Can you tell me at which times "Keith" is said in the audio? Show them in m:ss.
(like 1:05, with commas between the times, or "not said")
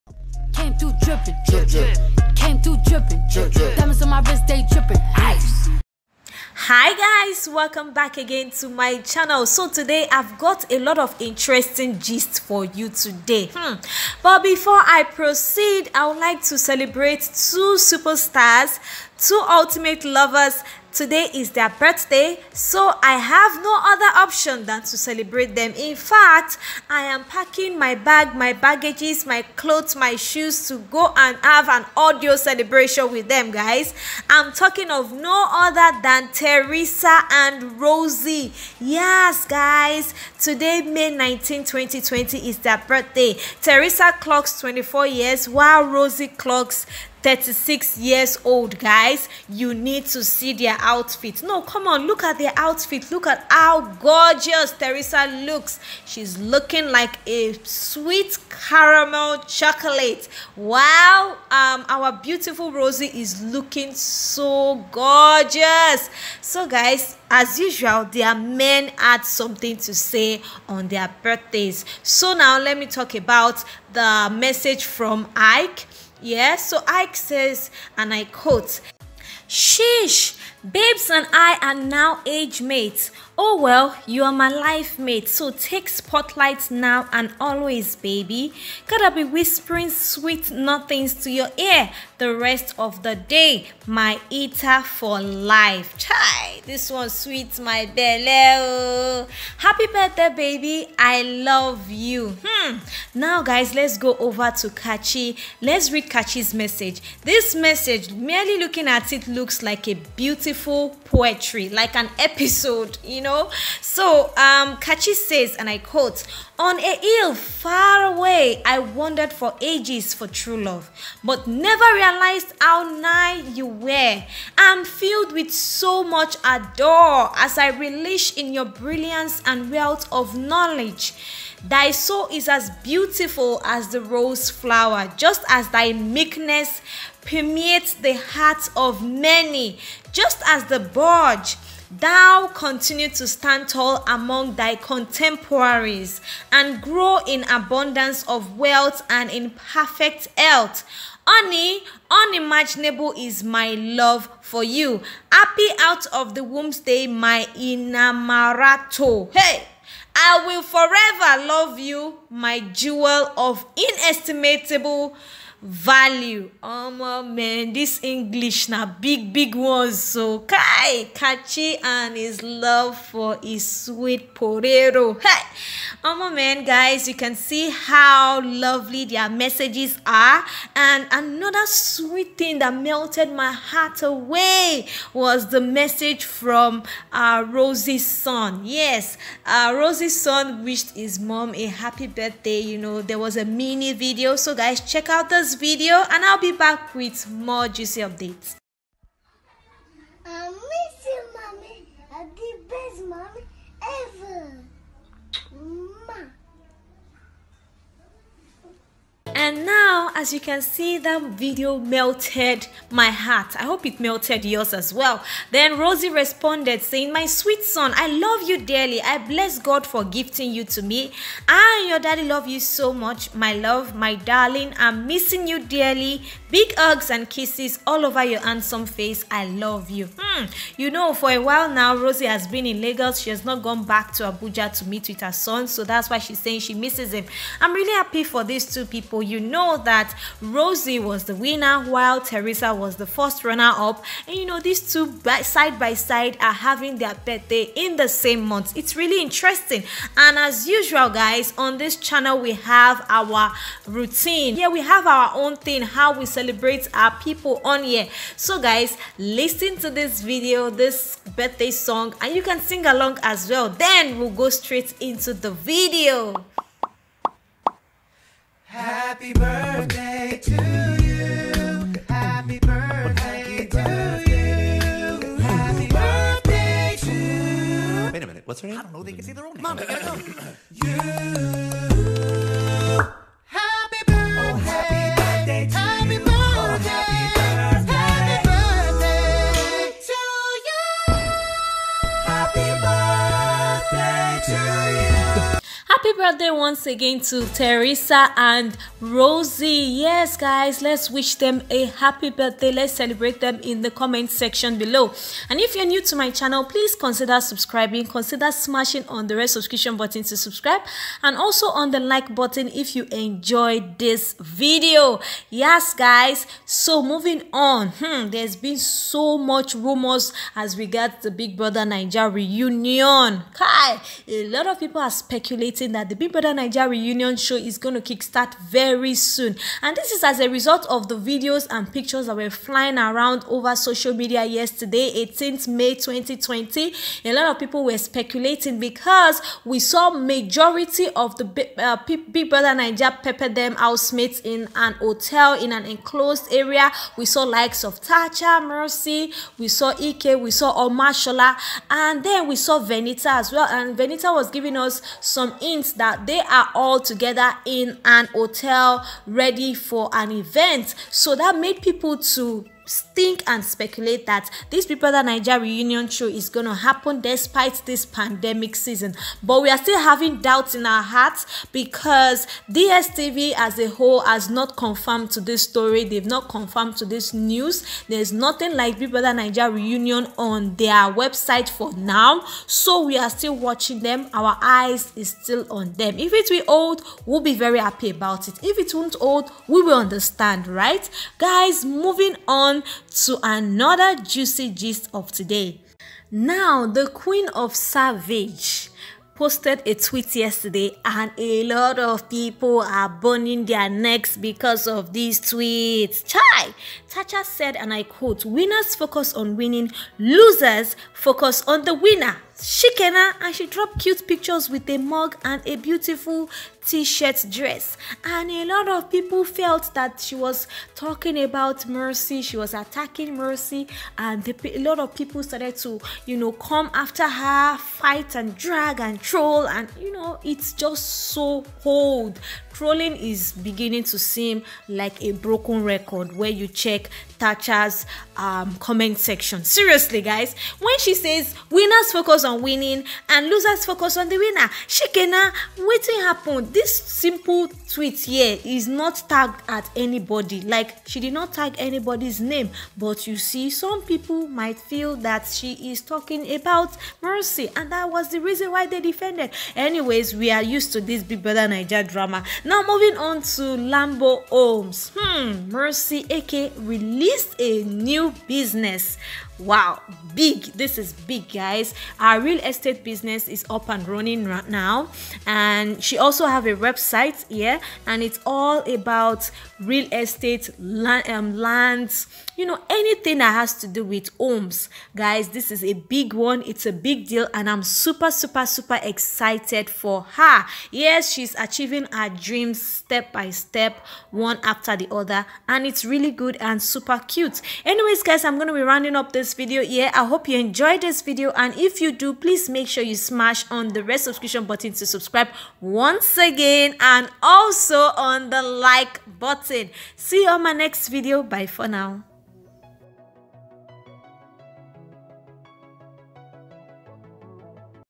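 not said.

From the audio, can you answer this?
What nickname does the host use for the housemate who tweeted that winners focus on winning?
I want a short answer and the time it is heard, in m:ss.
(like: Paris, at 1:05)
Queen of Savage, at 6:37.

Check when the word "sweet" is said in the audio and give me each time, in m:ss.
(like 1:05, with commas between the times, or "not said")
0:57, 1:29, 1:37, 2:53, 3:01, 3:37.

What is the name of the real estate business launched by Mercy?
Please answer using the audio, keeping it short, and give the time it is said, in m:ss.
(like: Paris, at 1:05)
Lambo Homes, at 7:43.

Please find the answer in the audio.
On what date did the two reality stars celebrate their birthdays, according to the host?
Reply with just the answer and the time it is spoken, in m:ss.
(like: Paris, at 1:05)
May 19, 2020, at 0:40.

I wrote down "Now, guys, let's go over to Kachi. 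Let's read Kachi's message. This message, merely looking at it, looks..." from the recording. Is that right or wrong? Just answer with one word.
right.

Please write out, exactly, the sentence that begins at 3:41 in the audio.
I and your daddy love you so much.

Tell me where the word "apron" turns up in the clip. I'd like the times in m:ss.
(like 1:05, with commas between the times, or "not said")
not said.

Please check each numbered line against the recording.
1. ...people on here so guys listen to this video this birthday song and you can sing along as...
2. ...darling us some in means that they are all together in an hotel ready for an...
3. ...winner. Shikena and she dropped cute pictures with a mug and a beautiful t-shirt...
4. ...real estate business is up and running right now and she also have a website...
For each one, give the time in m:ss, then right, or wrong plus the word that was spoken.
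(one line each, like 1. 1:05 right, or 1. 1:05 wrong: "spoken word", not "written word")
1. 4:17 right
2. 5:54 wrong: "giving", not "darling"
3. 6:51 right
4. 7:52 right.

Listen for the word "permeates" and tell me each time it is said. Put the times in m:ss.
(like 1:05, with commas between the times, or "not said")
2:17.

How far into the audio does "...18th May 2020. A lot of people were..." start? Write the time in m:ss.
5:35.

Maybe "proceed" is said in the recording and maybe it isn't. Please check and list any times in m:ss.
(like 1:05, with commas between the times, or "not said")
0:15.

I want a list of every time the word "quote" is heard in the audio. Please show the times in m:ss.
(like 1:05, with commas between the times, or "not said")
1:18, 1:55, 6:48.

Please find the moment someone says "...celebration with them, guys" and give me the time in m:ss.
0:32.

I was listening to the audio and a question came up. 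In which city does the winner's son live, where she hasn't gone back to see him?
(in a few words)
Abuja.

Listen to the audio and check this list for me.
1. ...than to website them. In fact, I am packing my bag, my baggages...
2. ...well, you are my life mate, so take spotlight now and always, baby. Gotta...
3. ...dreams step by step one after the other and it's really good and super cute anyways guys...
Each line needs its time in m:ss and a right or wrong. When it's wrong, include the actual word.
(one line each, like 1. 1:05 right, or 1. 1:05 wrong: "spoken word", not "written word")
1. 0:24 wrong: "celebrate", not "website"
2. 1:23 right
3. 8:12 right.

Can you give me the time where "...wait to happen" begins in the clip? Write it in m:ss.
7:25.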